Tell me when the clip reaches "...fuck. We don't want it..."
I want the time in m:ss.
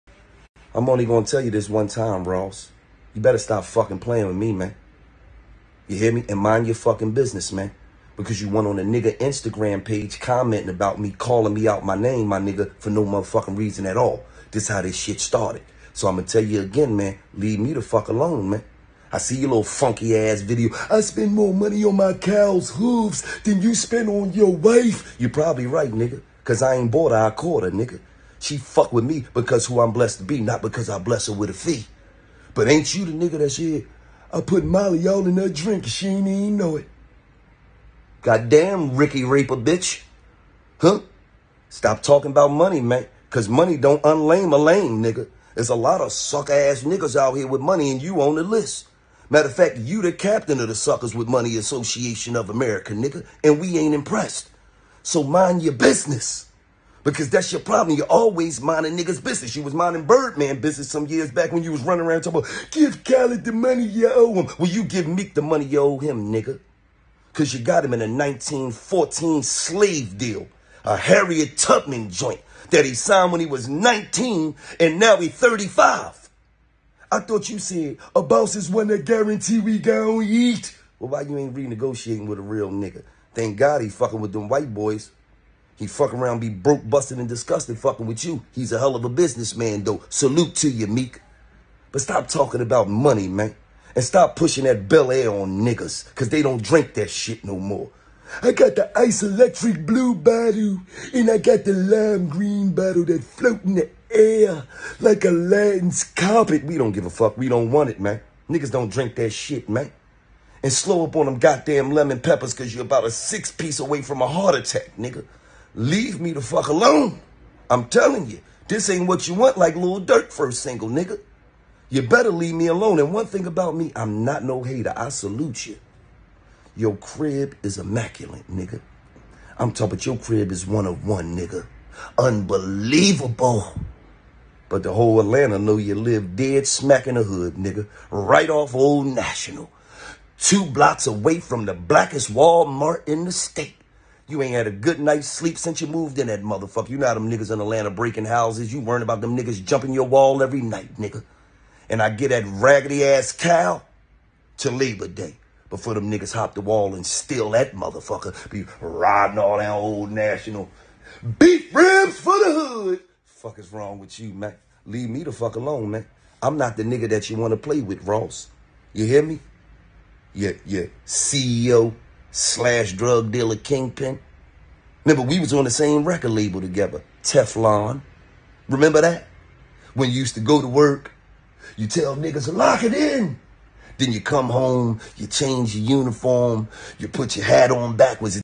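1:47.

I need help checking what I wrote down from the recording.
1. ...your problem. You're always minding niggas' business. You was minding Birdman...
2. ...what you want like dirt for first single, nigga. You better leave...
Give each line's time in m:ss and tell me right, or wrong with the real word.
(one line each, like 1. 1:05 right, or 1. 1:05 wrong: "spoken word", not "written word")
1. 0:57 right
2. 1:59 right.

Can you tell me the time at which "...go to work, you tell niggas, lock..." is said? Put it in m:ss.
3:00.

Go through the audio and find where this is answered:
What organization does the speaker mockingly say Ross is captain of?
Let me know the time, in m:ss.
0:50.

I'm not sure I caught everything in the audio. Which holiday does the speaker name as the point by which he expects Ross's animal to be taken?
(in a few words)
Labor Day.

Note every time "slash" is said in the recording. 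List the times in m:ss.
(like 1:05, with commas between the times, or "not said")
2:52.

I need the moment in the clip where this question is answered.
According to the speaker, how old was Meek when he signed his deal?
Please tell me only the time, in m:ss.
1:13.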